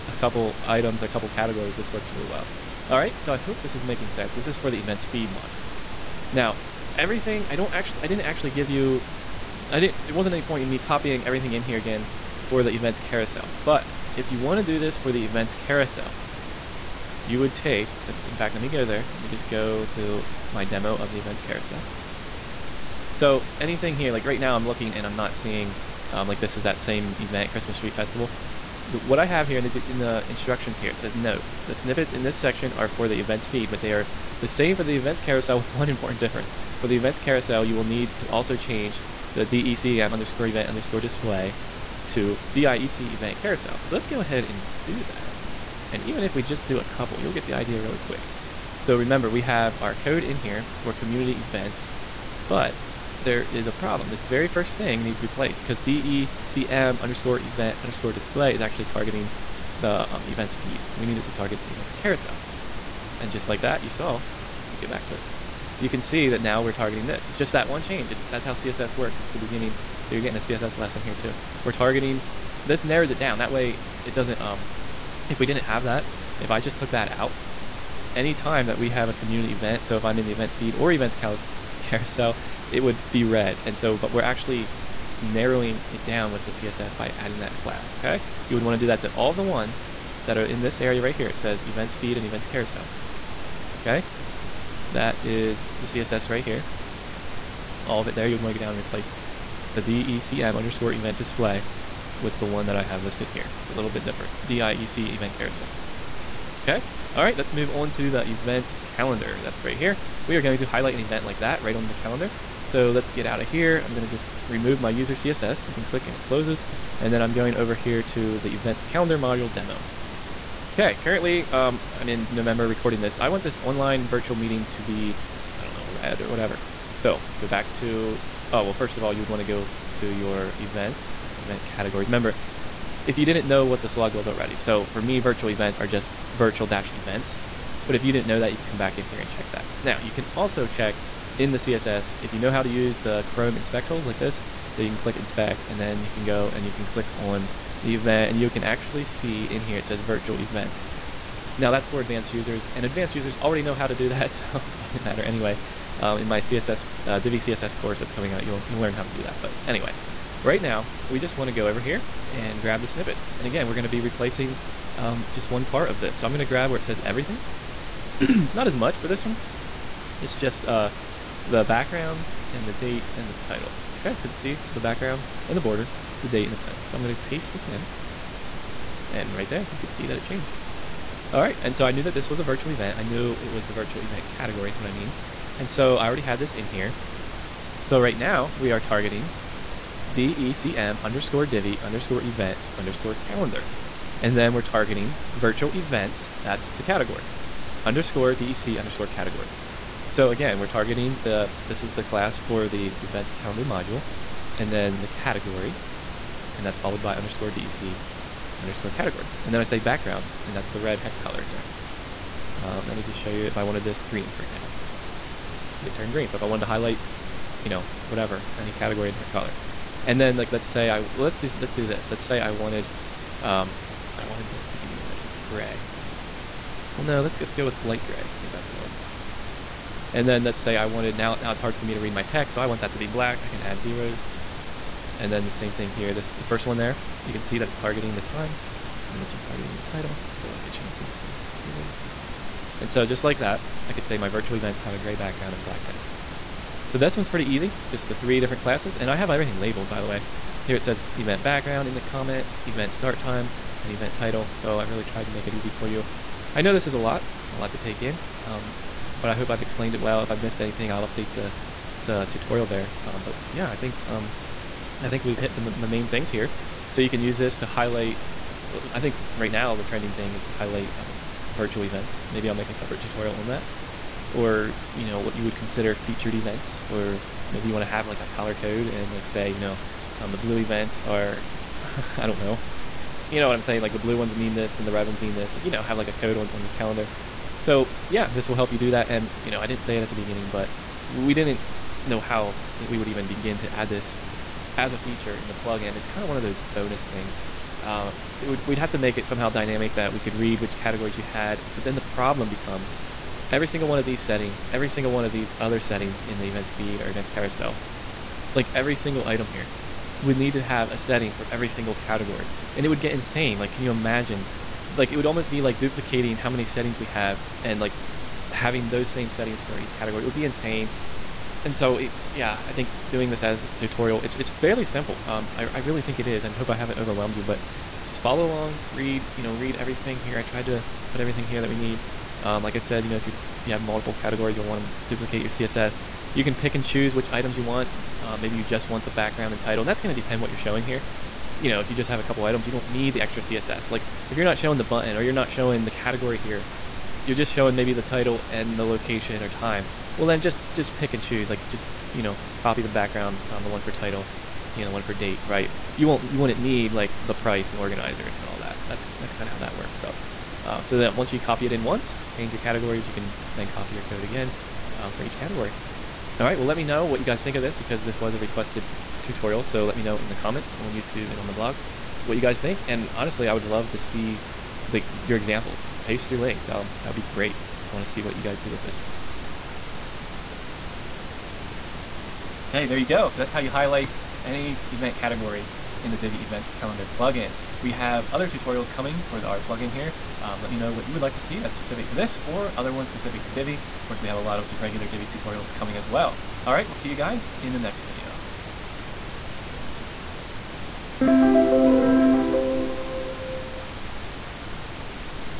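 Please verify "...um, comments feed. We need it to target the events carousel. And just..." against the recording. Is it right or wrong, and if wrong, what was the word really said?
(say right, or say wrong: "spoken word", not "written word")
wrong: "events", not "comments".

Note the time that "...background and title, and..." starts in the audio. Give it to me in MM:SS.
05:39.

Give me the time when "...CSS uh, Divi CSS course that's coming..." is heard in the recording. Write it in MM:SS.
02:36.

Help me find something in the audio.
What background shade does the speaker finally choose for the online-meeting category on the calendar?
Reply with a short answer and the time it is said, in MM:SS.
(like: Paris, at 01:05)
light gray, at 03:47.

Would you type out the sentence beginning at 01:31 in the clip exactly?
It says events feed and events carousel.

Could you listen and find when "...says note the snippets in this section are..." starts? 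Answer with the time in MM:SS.
00:30.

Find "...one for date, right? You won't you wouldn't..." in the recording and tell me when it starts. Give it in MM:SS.
05:54.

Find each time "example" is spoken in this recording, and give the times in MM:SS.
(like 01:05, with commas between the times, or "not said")
03:34, 06:15.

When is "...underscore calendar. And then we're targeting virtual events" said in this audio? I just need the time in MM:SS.
03:12.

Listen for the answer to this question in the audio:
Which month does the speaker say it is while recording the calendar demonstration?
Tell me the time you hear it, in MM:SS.
02:02.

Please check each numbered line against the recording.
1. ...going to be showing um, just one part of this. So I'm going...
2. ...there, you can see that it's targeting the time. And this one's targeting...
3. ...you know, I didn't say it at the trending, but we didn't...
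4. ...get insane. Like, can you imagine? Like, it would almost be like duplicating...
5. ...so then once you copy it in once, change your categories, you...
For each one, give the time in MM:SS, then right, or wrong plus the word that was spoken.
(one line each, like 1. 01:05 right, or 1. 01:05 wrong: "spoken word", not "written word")
1. 02:43 wrong: "replacing", not "showing"
2. 03:56 right
3. 04:49 wrong: "beginning", not "trending"
4. 05:12 right
5. 06:00 right.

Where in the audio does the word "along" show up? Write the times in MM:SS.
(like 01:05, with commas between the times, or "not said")
05:28.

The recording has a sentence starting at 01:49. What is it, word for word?
That's right here we are going to highlight an event like that right on the calendar.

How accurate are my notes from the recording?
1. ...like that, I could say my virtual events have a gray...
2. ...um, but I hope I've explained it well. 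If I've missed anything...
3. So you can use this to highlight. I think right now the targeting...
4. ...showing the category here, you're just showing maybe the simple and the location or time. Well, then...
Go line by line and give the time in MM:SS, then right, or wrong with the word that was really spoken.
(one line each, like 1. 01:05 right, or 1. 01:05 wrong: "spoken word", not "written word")
1. 04:03 right
2. 04:18 right
3. 04:26 wrong: "trending", not "targeting"
4. 05:45 wrong: "title", not "simple".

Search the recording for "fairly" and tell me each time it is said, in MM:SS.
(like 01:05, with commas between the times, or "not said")
05:24.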